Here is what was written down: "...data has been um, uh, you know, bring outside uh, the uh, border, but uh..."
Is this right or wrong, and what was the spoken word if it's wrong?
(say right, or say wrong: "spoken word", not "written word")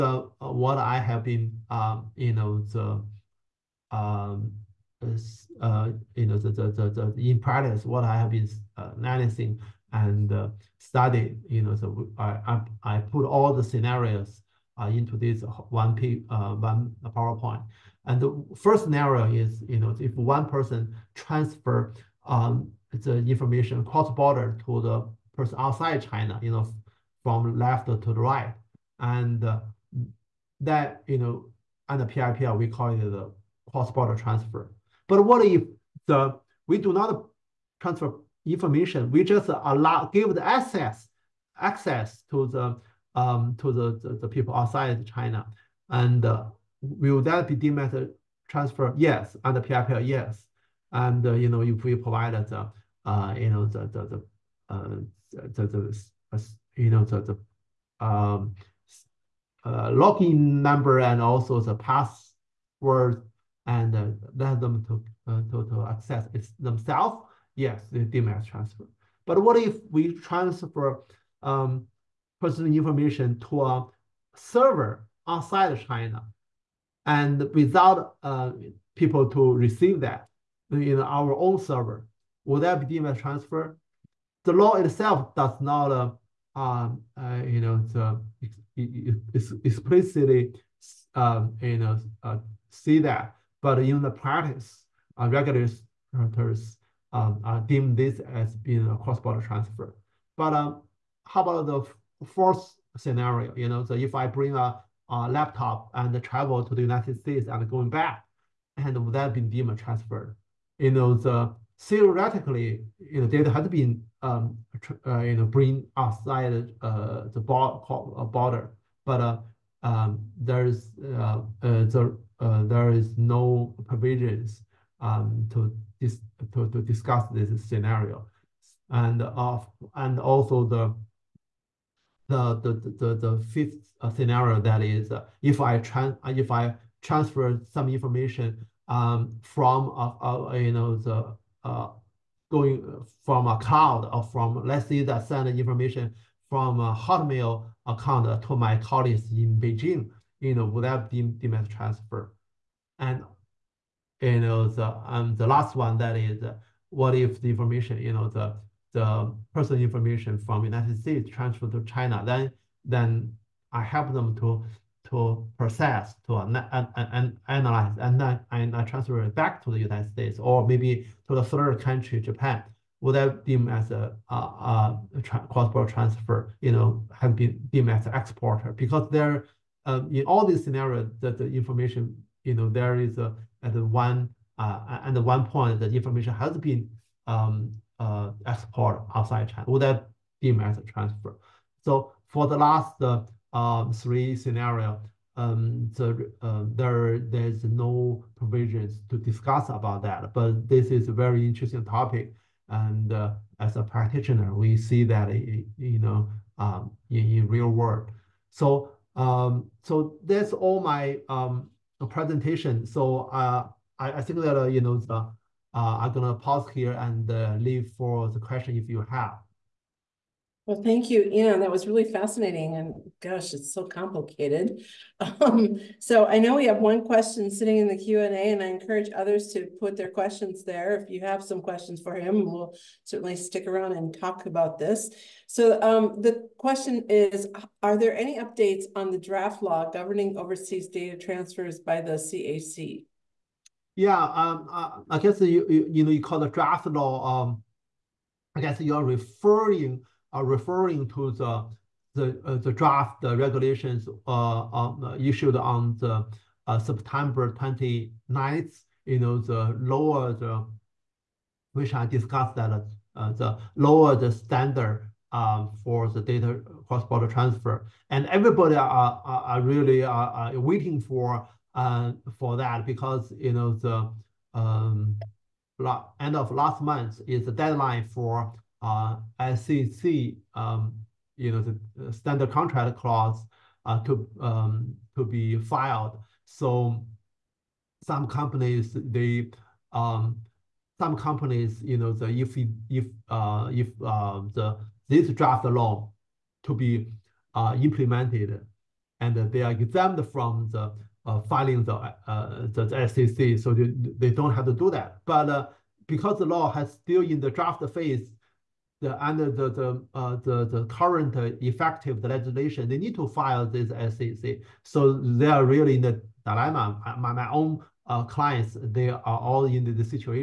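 right.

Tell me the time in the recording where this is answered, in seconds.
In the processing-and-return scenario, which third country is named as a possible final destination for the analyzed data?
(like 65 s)
172 s.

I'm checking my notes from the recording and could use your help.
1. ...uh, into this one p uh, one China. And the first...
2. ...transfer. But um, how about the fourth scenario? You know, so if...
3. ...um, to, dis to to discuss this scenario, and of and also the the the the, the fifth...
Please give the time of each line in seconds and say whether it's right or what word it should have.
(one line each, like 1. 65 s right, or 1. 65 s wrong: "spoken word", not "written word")
1. 14 s wrong: "PowerPoint", not "China"
2. 99 s right
3. 124 s right.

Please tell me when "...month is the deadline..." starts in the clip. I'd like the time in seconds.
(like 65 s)
276 s.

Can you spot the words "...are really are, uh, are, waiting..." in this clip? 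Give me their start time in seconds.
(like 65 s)
269 s.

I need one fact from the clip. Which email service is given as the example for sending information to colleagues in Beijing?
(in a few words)
Hotmail.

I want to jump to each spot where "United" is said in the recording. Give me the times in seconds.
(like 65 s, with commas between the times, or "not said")
106 s, 160 s, 169 s.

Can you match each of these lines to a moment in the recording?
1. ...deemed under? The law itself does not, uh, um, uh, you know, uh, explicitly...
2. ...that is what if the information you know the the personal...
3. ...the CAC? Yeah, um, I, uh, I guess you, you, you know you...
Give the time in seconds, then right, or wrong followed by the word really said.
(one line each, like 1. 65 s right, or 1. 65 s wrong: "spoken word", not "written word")
1. 82 s wrong: "transfer", not "under"
2. 155 s right
3. 242 s right.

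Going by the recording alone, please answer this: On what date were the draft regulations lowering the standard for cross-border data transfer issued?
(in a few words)
September 29.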